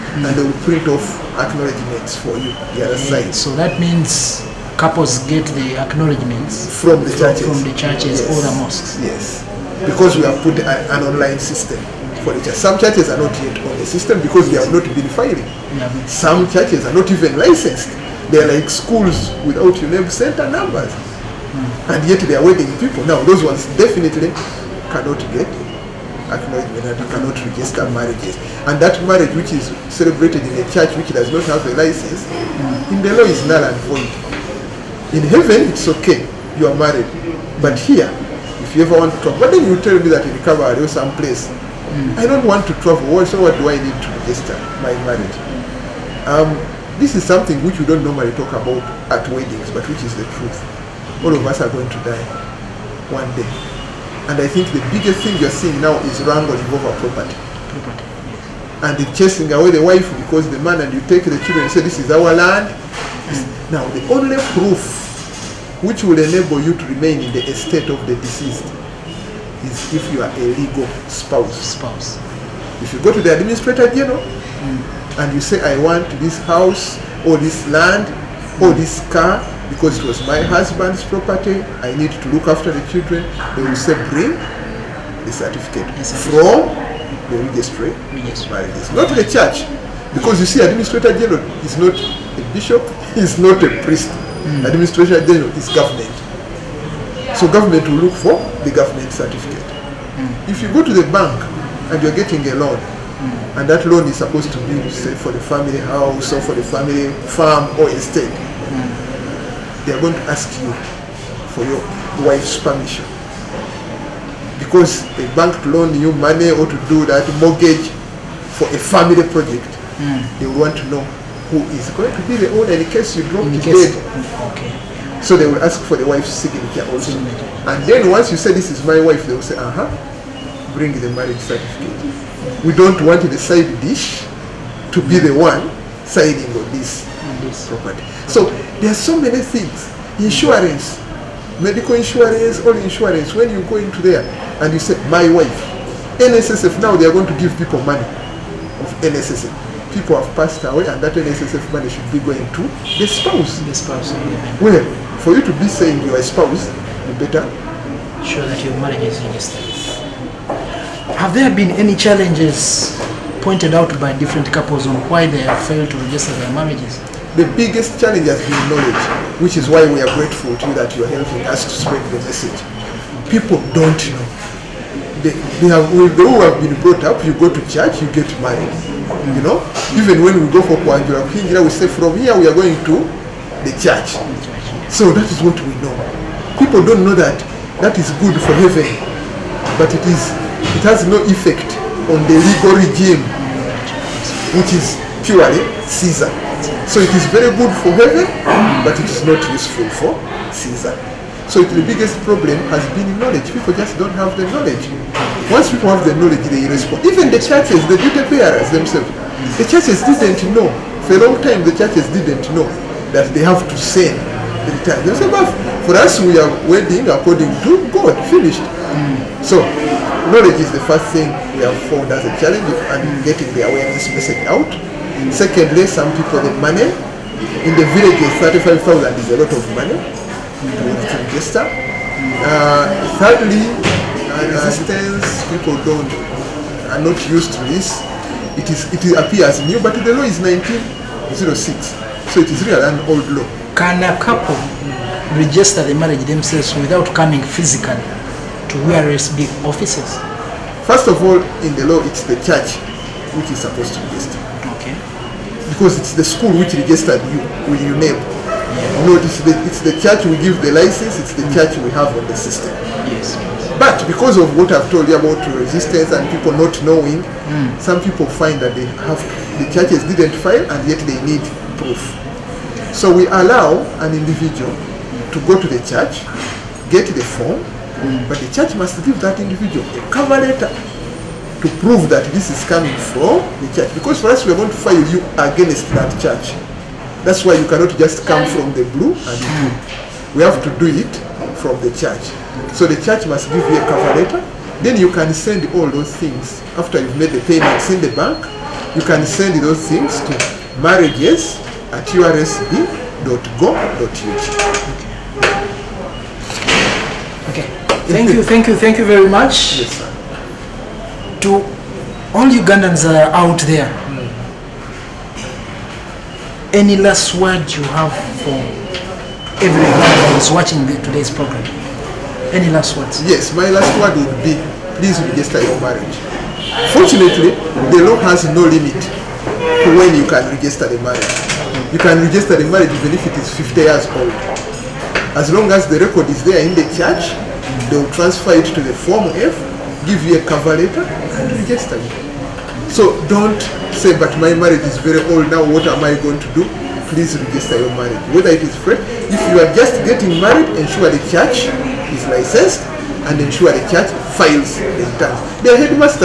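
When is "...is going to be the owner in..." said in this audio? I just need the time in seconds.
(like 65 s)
121 s.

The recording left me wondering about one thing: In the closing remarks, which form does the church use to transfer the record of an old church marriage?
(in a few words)
Form F.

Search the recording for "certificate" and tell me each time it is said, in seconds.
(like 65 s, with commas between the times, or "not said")
85 s, 99 s, 131 s.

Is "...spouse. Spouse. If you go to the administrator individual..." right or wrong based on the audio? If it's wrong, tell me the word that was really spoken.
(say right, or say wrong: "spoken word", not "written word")
wrong: "general", not "individual".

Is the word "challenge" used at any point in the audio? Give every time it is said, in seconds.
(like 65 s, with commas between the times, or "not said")
161 s, 167 s, 222 s.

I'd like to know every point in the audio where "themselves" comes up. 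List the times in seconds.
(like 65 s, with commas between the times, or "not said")
208 s, 246 s.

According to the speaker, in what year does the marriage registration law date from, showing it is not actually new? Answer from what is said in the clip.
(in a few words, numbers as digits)
1906.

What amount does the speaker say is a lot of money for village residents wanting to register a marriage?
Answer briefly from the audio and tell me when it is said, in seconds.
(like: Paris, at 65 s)
35,000, at 228 s.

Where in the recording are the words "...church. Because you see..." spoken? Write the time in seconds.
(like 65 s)
89 s.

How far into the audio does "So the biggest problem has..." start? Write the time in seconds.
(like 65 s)
201 s.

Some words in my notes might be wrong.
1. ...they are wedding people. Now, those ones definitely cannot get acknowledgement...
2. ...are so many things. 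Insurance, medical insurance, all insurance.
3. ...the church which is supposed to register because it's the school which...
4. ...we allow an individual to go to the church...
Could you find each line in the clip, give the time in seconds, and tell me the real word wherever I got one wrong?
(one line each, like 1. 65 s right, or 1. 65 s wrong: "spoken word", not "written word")
1. 22 s right
2. 138 s right
3. 252 s right
4. 273 s right.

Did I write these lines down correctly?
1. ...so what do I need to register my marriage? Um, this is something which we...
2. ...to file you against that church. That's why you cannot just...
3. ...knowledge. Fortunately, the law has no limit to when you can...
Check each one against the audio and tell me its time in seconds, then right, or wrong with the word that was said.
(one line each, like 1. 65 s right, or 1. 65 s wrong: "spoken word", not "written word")
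1. 43 s right
2. 284 s right
3. 325 s wrong: "marriage", not "knowledge".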